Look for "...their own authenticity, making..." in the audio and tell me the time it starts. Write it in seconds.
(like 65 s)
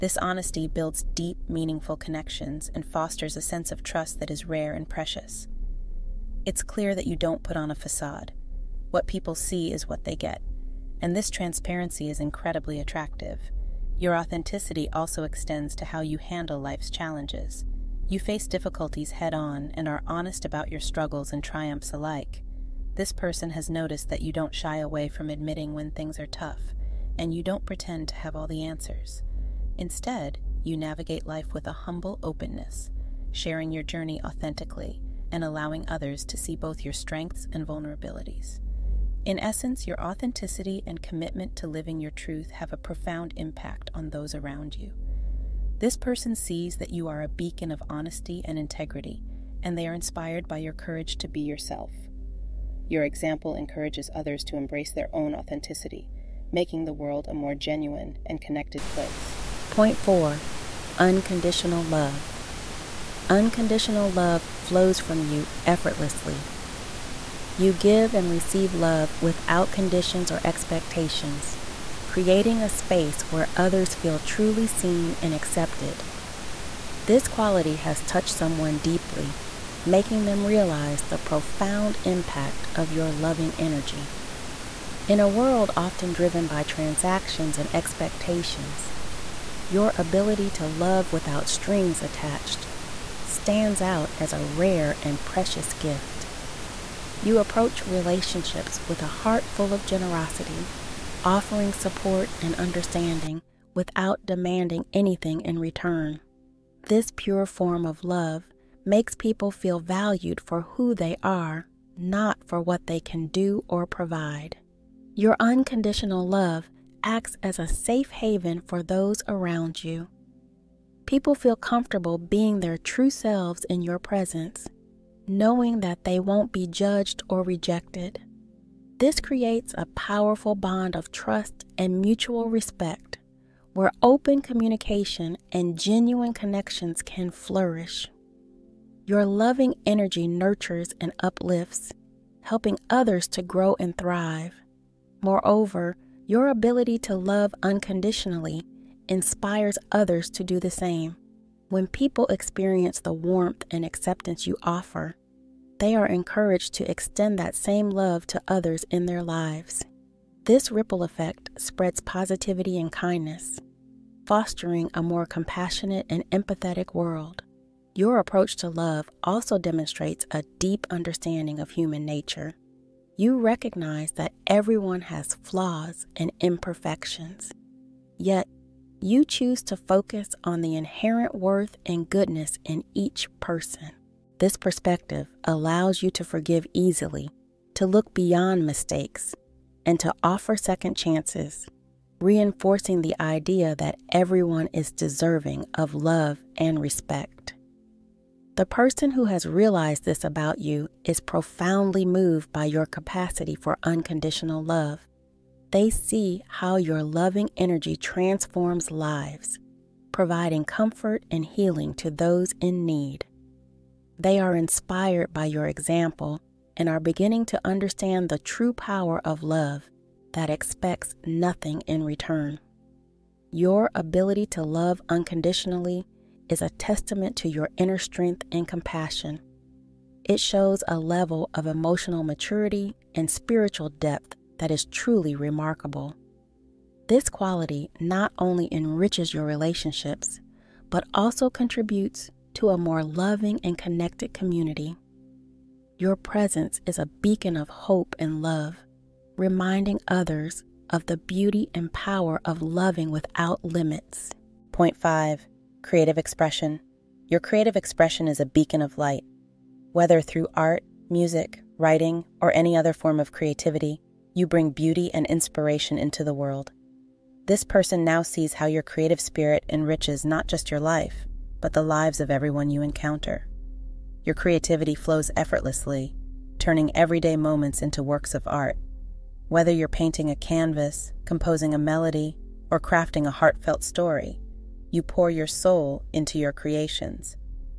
54 s.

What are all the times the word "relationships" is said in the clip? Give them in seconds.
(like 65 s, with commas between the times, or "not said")
97 s, 239 s.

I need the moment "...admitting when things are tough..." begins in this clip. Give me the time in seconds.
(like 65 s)
25 s.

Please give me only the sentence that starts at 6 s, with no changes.
It's clear that you don't put on a facade.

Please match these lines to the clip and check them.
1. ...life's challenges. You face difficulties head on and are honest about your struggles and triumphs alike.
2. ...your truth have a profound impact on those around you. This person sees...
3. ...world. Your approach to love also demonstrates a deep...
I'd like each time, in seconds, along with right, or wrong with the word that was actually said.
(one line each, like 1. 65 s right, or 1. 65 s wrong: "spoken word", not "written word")
1. 16 s right
2. 42 s right
3. 166 s right.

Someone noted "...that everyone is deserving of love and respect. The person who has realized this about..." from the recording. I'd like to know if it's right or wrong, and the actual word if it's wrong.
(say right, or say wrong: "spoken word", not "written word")
right.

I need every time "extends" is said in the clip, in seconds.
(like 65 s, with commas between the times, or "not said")
15 s, 156 s.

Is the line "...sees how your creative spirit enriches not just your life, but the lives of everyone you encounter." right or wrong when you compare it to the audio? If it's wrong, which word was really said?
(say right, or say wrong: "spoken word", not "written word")
right.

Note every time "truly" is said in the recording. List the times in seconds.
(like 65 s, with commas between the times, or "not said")
74 s, 234 s.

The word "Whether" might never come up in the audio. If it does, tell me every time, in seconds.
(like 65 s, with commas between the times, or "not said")
259 s, 279 s.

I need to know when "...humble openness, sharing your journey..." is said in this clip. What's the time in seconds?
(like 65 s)
31 s.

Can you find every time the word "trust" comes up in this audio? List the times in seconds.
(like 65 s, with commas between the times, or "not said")
3 s, 131 s.